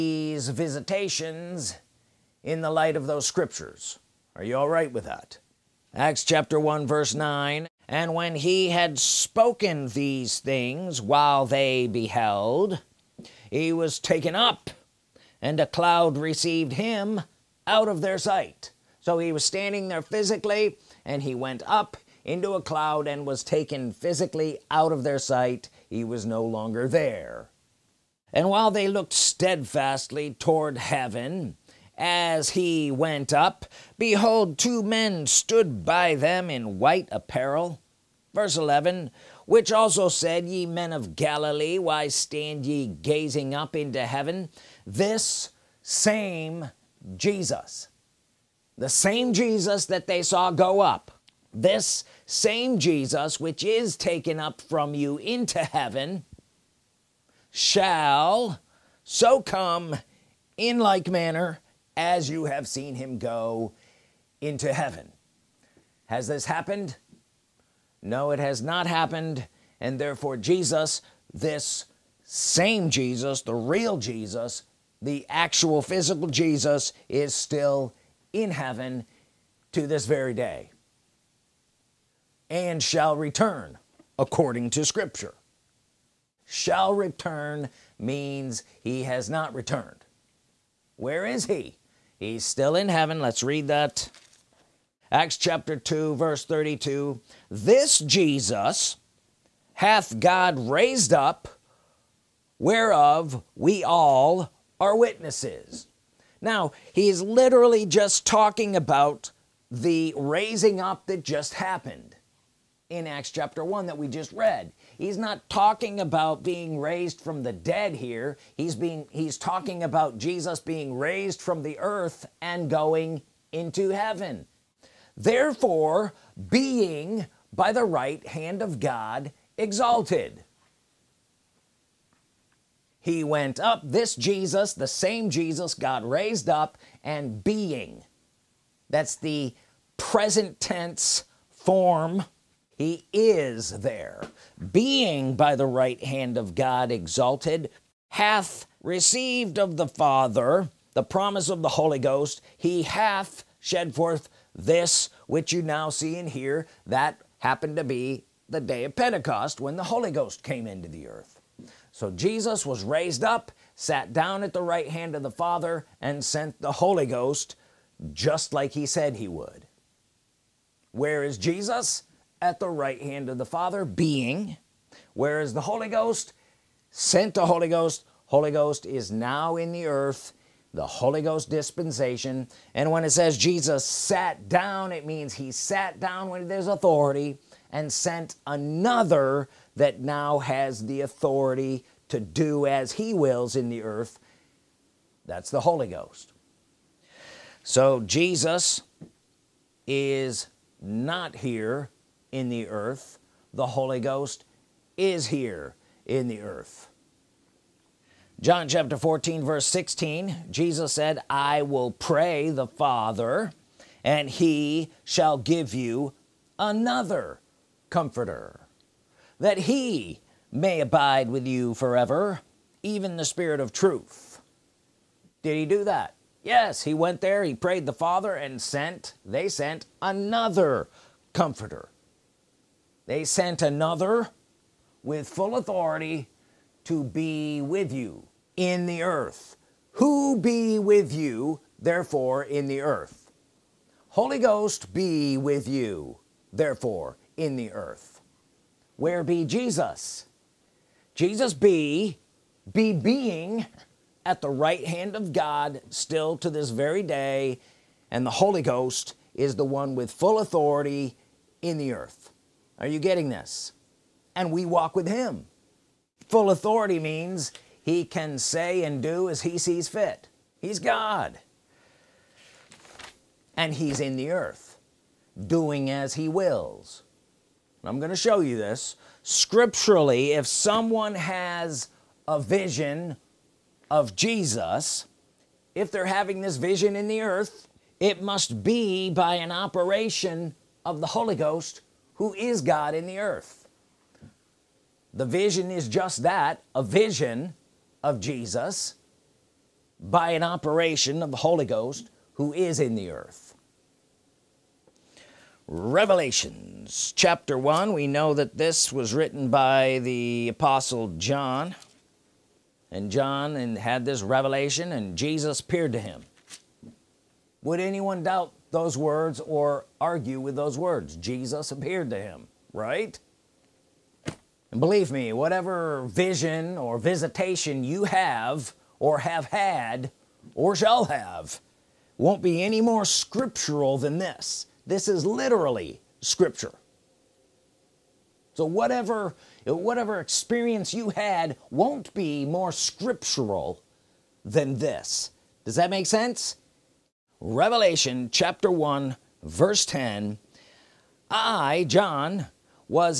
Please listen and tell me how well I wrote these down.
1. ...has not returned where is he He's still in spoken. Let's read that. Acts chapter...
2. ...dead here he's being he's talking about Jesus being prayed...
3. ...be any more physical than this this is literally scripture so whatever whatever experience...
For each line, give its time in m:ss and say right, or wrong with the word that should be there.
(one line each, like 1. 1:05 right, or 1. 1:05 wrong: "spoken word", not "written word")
1. 1:29 wrong: "heaven", not "spoken"
2. 1:57 wrong: "raised", not "prayed"
3. 5:32 wrong: "scriptural", not "physical".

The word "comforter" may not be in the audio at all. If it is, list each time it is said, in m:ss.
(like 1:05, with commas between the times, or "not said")
3:37, 3:51.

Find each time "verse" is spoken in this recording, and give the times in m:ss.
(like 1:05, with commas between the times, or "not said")
0:06, 0:38, 1:36, 3:29, 5:49.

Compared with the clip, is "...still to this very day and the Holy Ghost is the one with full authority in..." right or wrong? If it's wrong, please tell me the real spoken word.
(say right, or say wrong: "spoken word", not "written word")
right.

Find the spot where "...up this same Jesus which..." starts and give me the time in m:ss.
0:50.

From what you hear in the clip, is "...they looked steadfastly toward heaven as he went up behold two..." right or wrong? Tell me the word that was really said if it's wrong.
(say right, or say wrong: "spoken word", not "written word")
right.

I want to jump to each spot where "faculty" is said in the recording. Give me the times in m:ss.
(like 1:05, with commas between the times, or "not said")
not said.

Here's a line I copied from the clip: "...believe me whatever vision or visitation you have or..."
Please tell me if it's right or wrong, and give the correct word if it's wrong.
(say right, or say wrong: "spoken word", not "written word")
right.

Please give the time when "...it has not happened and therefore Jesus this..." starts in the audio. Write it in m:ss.
1:08.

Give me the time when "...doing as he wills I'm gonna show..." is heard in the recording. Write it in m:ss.
4:35.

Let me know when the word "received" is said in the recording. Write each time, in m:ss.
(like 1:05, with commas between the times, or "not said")
0:16, 2:28.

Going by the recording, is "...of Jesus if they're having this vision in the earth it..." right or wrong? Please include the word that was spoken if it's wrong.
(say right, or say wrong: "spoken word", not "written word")
right.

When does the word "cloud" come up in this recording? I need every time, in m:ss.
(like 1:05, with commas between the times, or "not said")
0:15, 0:22.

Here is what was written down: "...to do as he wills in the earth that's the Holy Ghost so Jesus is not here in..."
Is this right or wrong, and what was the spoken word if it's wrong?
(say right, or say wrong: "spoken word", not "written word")
right.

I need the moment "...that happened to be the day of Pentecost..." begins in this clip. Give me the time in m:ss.
2:36.